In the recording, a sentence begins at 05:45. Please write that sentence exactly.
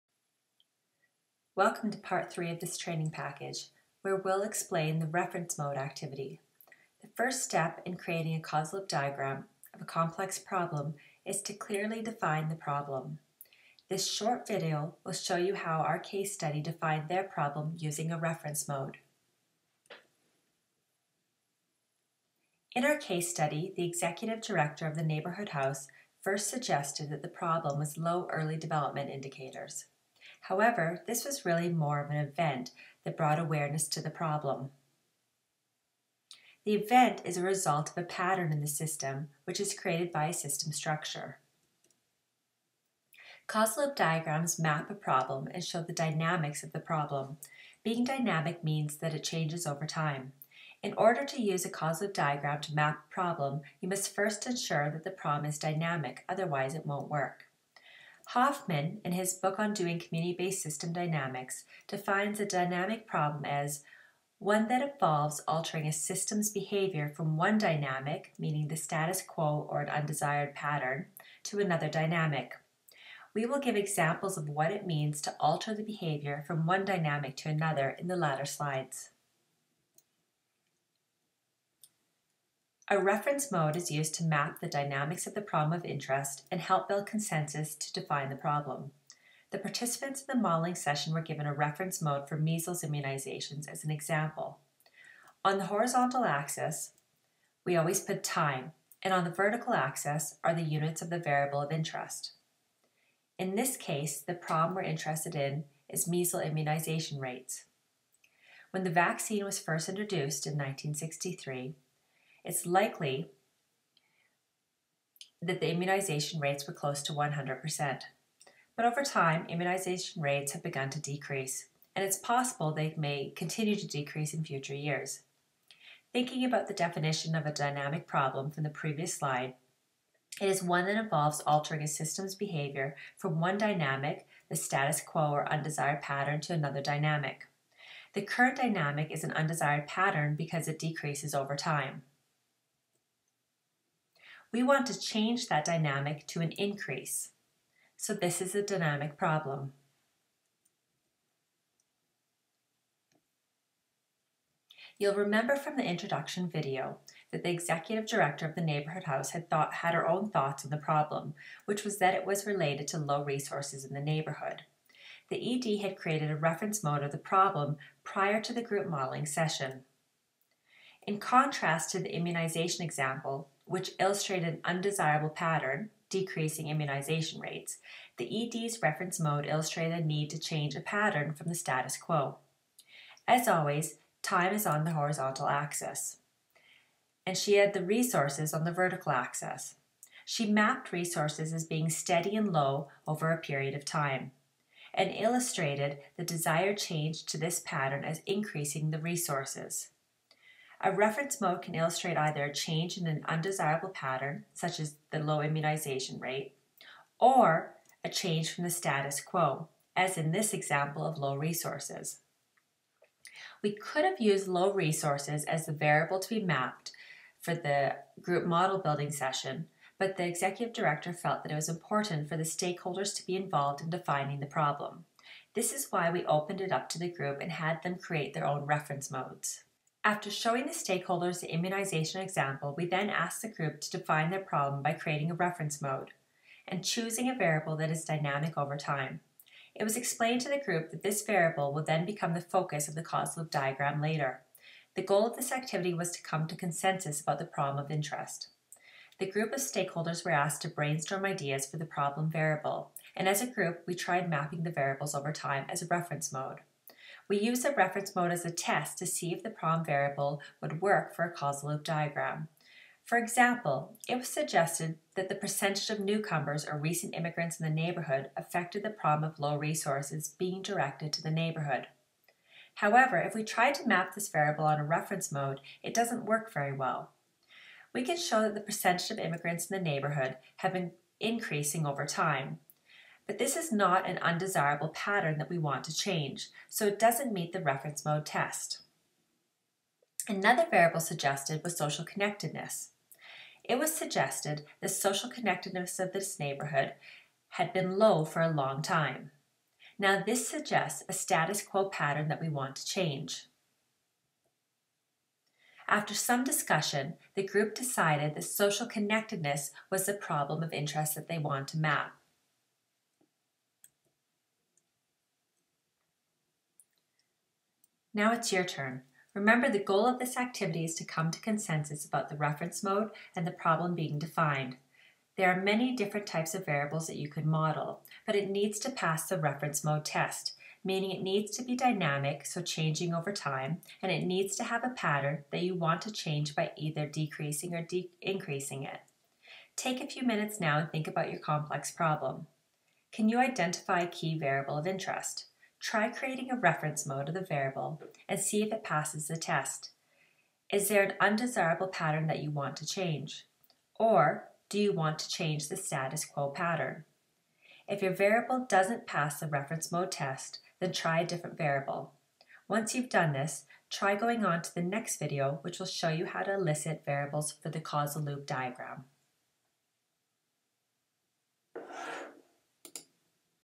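try creating a reference mode of the variable and see if it passes the test.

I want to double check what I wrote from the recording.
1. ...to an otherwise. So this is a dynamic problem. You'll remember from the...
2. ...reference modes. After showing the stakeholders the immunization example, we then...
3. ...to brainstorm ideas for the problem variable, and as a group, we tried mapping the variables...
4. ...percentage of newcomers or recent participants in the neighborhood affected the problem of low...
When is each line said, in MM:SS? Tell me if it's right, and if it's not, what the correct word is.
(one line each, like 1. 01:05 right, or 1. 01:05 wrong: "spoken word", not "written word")
1. 02:26 wrong: "increase", not "otherwise"
2. 03:48 right
3. 04:10 right
4. 04:25 wrong: "immigrants", not "participants".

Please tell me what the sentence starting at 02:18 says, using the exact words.
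The current dynamic is an undesired pattern because it decreases over time.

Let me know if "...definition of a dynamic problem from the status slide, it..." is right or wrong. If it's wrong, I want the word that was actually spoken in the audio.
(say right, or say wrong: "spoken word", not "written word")
wrong: "previous", not "status".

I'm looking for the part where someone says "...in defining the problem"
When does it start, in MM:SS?
03:43.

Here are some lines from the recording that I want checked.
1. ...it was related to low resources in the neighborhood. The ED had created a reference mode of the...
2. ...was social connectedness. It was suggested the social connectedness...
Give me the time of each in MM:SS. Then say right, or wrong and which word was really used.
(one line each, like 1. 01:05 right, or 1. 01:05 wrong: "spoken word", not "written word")
1. 02:42 right
2. 04:51 right.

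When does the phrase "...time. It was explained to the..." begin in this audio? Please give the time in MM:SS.
03:58.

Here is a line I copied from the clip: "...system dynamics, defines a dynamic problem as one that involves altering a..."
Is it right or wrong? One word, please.
right.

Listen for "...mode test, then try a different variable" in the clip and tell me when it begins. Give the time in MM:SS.
05:59.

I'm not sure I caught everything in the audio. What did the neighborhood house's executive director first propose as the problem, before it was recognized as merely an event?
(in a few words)
Low early development indicators.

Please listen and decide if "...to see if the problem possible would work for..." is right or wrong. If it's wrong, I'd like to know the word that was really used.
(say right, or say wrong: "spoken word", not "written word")
wrong: "variable", not "possible".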